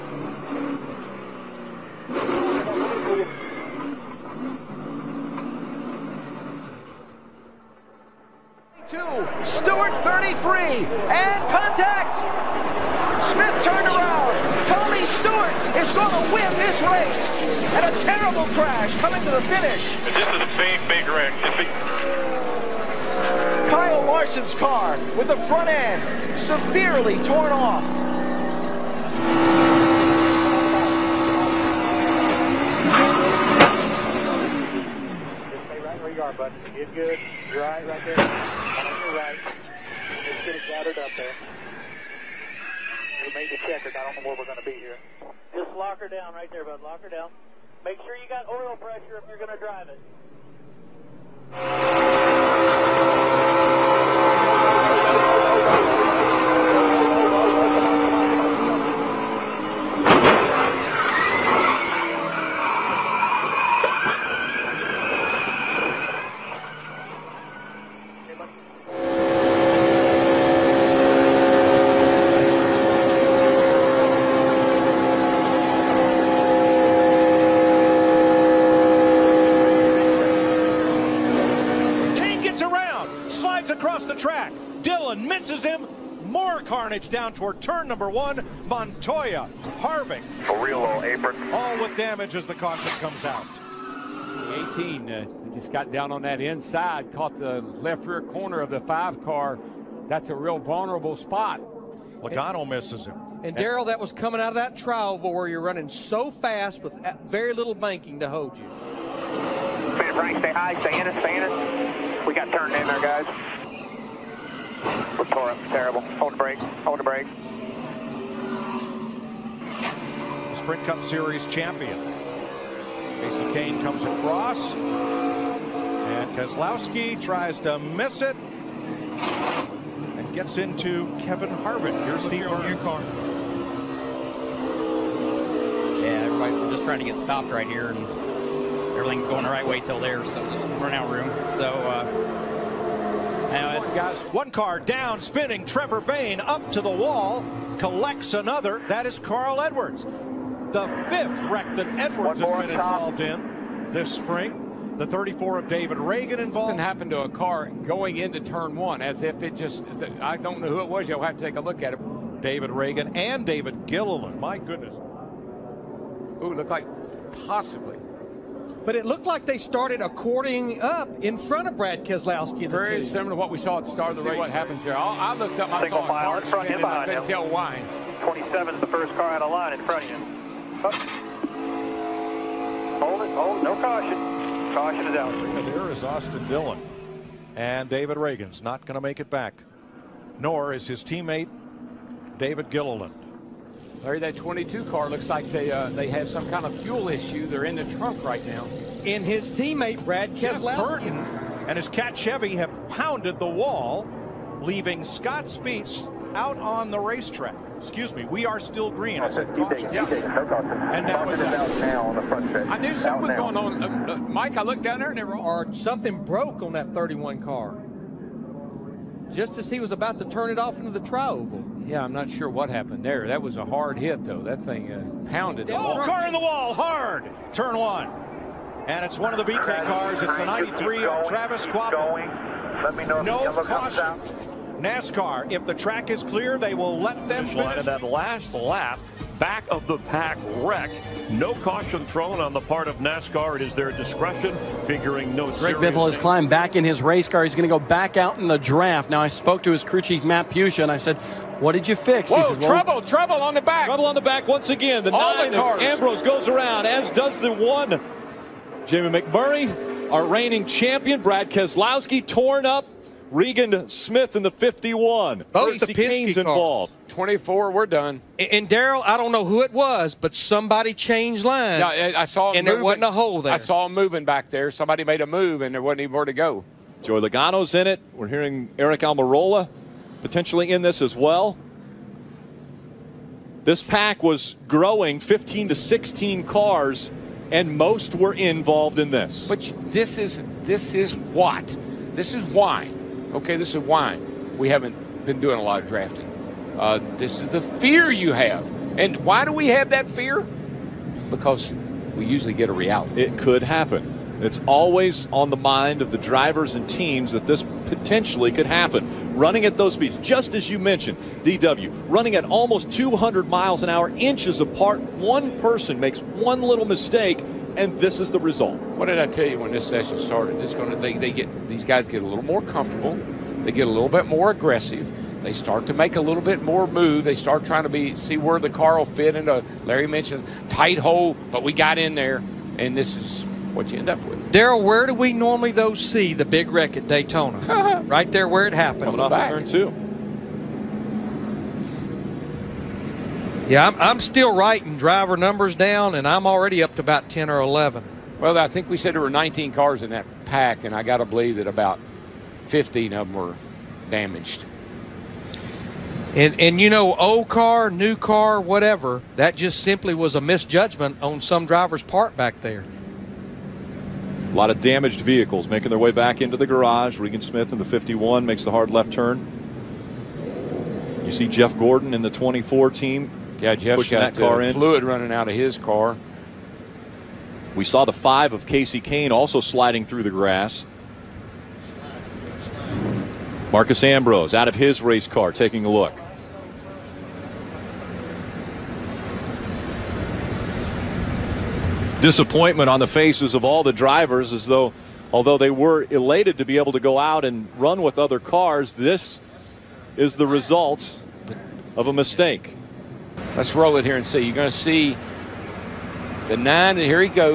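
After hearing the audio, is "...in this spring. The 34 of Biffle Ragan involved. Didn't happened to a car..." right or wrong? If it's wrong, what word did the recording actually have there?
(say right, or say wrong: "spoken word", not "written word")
wrong: "David", not "Biffle".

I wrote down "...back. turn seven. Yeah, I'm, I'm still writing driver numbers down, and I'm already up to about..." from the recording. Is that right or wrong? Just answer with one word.
wrong.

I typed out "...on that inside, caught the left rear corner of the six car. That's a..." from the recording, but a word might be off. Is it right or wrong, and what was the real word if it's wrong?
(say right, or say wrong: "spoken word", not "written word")
wrong: "five", not "six".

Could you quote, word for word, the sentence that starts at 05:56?
And, and you know, old car, new car, whatever, that just simply was a misjudgment on some driver's part back there.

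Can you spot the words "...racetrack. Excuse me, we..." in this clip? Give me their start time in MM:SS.
03:26.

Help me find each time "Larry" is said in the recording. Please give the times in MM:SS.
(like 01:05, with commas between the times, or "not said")
03:14, 05:29.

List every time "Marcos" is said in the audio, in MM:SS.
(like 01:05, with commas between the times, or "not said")
06:23.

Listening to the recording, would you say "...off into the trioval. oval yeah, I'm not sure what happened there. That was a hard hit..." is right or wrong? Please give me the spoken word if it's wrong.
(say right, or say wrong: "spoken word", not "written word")
right.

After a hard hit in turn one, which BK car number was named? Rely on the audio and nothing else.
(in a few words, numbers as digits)
93.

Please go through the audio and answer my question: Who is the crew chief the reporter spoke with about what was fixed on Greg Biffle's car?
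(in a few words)
Matt Puccia.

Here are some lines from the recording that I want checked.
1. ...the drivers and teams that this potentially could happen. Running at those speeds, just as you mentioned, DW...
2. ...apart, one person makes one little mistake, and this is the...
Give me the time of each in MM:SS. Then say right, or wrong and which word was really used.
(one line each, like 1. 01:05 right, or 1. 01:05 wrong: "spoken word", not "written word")
1. 05:06 right
2. 05:14 right.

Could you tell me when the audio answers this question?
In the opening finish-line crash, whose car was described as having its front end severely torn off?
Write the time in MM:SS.
00:23.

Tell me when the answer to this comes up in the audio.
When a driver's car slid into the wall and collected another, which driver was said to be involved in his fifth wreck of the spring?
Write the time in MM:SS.
02:29.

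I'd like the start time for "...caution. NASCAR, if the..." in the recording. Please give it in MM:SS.
03:53.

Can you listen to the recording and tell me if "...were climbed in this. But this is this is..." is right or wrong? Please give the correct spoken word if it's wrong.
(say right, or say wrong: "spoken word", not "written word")
wrong: "involved", not "climbed".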